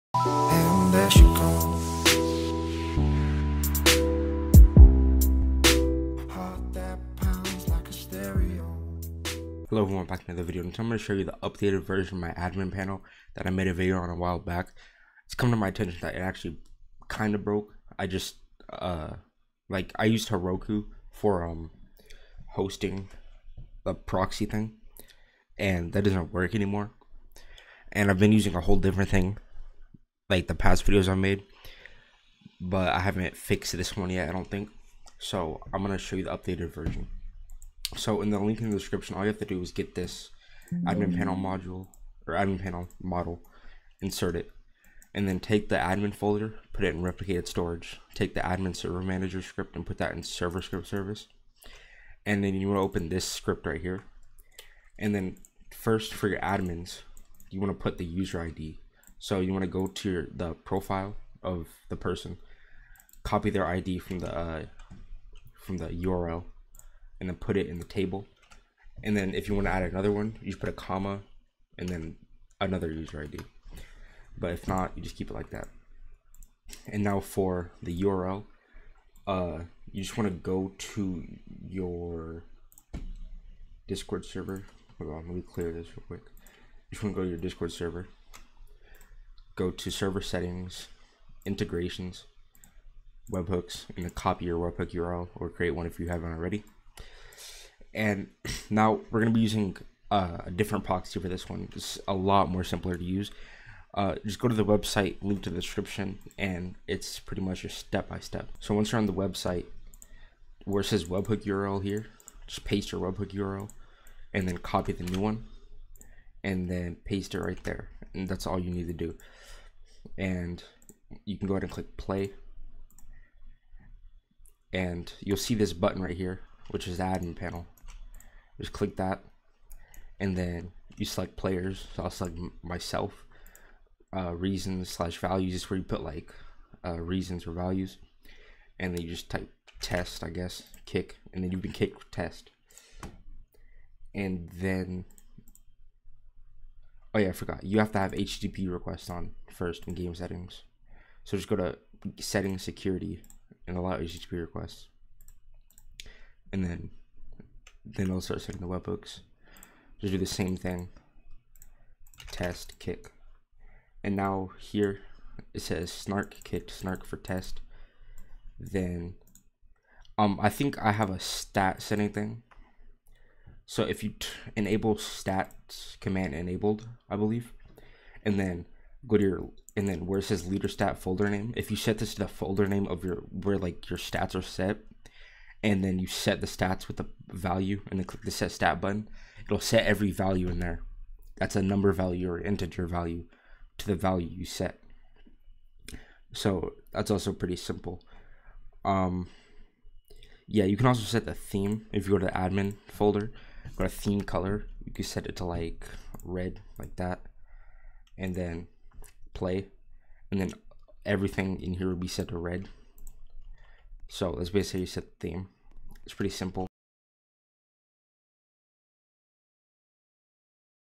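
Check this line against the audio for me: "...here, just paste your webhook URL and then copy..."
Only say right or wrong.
right.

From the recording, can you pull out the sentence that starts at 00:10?
And I'm going to show you the updated version of my admin panel that I made a video on a while back.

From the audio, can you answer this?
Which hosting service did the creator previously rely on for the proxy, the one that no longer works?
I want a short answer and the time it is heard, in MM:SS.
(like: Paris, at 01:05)
Heroku, at 00:20.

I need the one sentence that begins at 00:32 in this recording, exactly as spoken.
But I haven't fixed this one yet, I don't think.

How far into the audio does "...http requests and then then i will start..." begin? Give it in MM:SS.
02:33.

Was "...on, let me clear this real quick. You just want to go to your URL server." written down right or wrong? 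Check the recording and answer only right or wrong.
wrong.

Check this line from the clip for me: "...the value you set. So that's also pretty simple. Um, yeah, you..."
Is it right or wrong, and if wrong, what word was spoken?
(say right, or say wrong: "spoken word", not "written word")
right.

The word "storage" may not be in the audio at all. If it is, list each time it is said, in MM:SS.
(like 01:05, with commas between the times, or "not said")
00:47.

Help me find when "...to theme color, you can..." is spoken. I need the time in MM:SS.
03:23.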